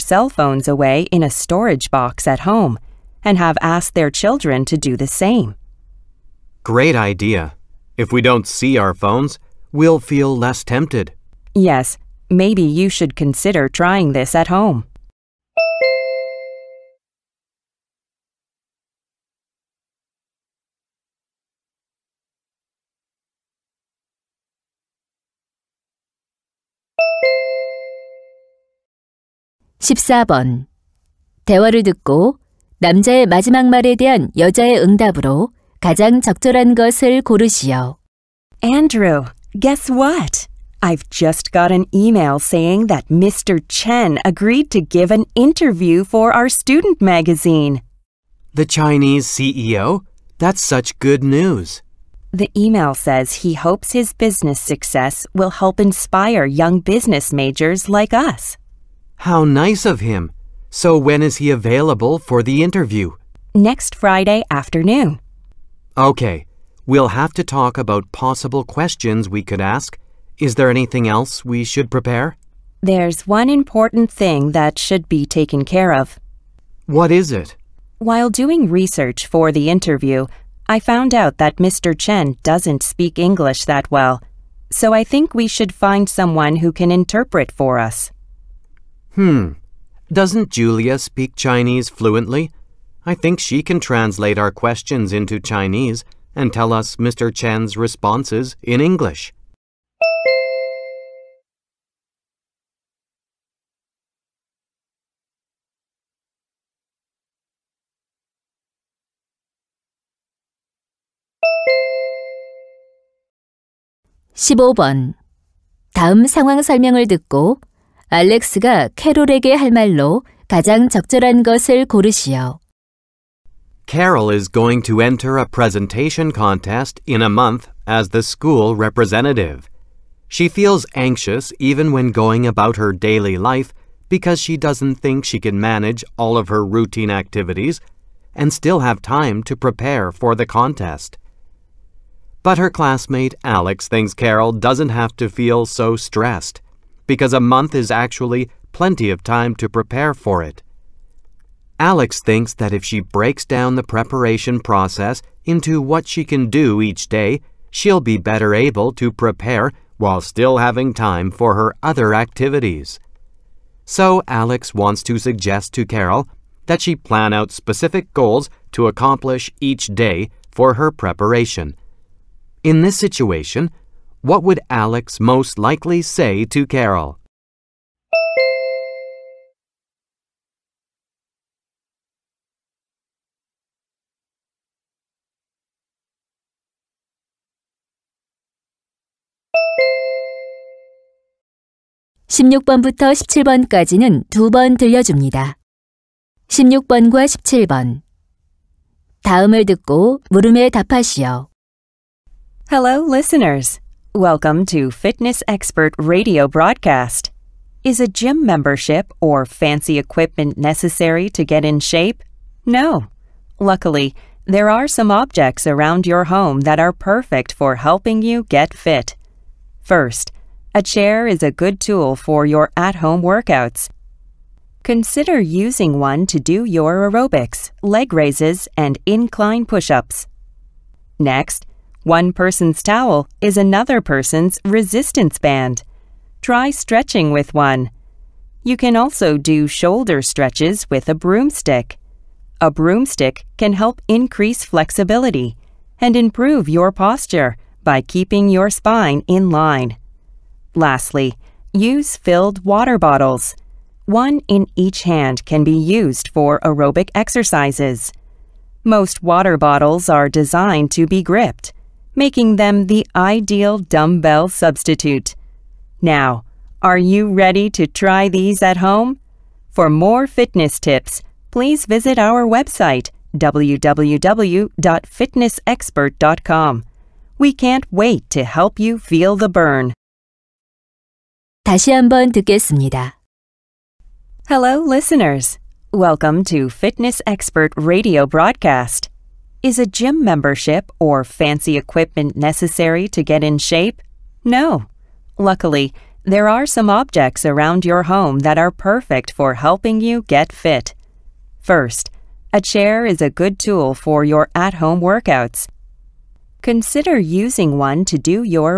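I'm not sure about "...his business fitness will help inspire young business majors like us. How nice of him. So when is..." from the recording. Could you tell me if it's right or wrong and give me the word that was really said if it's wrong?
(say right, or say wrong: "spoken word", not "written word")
wrong: "success", not "fitness".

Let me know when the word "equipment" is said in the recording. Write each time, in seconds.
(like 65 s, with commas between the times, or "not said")
210 s, 291 s.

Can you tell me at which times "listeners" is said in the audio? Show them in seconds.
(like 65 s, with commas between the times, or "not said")
203 s, 284 s.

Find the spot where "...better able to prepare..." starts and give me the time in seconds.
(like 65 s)
158 s.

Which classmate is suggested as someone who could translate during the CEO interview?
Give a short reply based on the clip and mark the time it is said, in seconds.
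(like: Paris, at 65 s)
Julia, at 90 s.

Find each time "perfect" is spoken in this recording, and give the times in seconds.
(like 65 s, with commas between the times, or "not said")
216 s, 298 s.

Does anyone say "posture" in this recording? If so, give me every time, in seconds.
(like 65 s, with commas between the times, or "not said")
246 s.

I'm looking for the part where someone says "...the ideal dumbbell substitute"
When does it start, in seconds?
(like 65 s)
262 s.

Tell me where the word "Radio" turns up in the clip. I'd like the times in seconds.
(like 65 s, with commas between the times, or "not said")
206 s, 287 s.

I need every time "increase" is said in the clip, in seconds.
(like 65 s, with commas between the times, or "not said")
244 s.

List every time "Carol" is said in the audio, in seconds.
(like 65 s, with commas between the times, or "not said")
123 s, 144 s, 165 s, 176 s.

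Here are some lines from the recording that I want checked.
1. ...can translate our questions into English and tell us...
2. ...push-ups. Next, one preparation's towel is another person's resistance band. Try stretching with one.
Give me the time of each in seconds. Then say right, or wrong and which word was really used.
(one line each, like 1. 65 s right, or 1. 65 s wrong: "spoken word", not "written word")
1. 93 s wrong: "Chinese", not "English"
2. 229 s wrong: "person", not "preparation".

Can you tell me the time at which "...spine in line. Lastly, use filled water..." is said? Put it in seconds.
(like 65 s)
248 s.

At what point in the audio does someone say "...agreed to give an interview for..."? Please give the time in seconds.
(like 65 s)
44 s.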